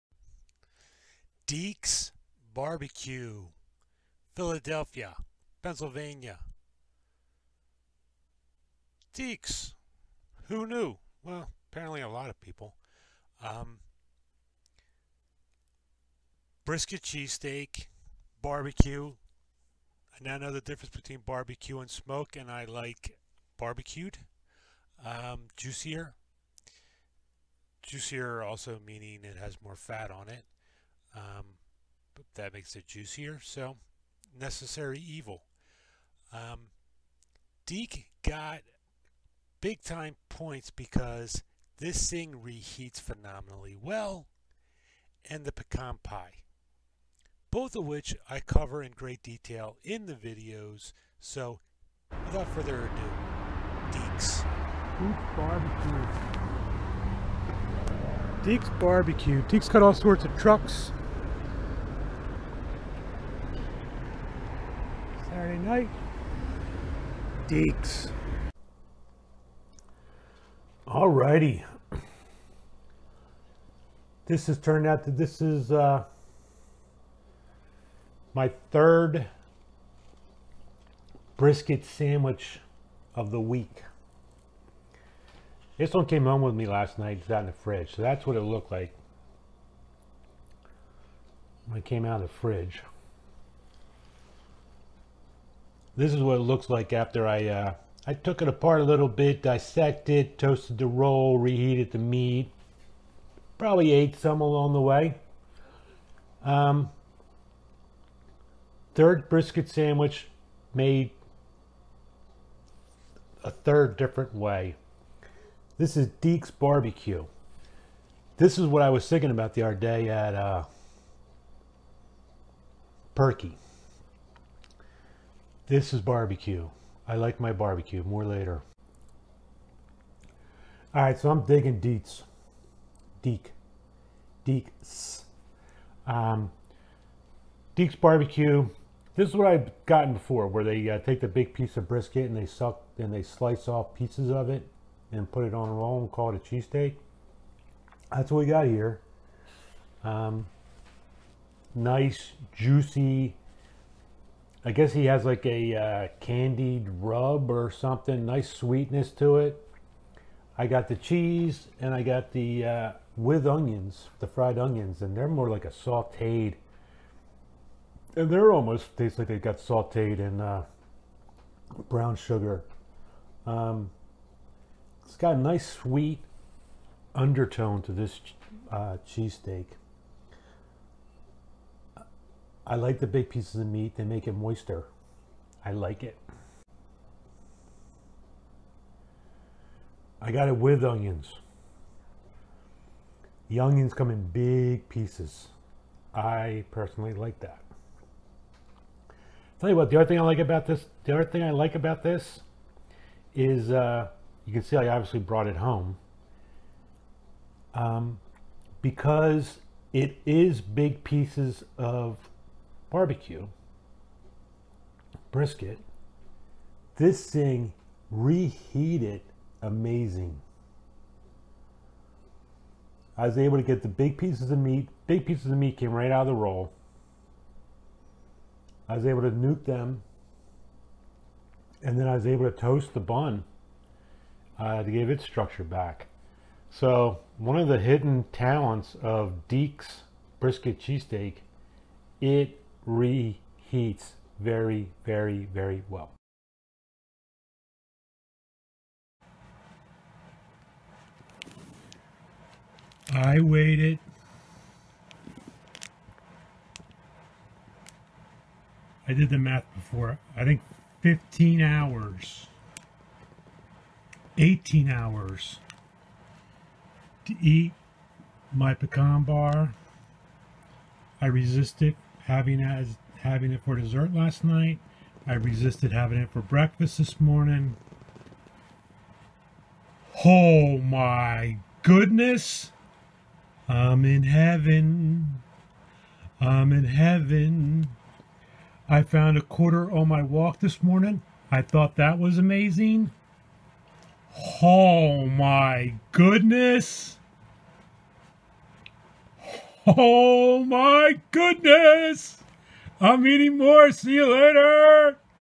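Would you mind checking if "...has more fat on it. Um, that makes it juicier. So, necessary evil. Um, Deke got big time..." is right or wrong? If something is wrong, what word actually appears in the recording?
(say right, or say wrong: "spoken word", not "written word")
right.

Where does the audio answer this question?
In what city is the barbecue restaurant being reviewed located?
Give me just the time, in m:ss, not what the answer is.
0:04.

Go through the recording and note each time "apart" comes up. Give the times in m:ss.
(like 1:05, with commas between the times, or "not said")
1:38.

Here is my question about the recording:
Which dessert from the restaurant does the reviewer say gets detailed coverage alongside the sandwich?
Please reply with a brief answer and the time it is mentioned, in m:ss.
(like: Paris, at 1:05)
pecan pie, at 0:45.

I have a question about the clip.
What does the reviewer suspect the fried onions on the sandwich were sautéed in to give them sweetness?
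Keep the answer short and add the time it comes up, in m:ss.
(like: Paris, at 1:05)
brown sugar, at 2:51.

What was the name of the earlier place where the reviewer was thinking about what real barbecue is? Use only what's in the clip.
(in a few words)
Perky.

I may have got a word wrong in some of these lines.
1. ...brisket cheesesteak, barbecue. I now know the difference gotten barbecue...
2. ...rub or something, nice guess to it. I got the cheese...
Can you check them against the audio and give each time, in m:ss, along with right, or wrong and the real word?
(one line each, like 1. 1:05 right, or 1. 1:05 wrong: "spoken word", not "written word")
1. 0:16 wrong: "between", not "gotten"
2. 2:36 wrong: "sweetness", not "guess".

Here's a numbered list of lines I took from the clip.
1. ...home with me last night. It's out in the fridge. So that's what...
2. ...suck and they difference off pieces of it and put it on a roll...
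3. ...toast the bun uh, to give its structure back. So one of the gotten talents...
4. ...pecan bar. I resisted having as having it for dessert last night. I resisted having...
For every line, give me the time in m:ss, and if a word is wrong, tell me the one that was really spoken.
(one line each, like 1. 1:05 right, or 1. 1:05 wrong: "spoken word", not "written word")
1. 1:26 right
2. 2:22 wrong: "slice", not "difference"
3. 3:52 wrong: "hidden", not "gotten"
4. 4:28 right.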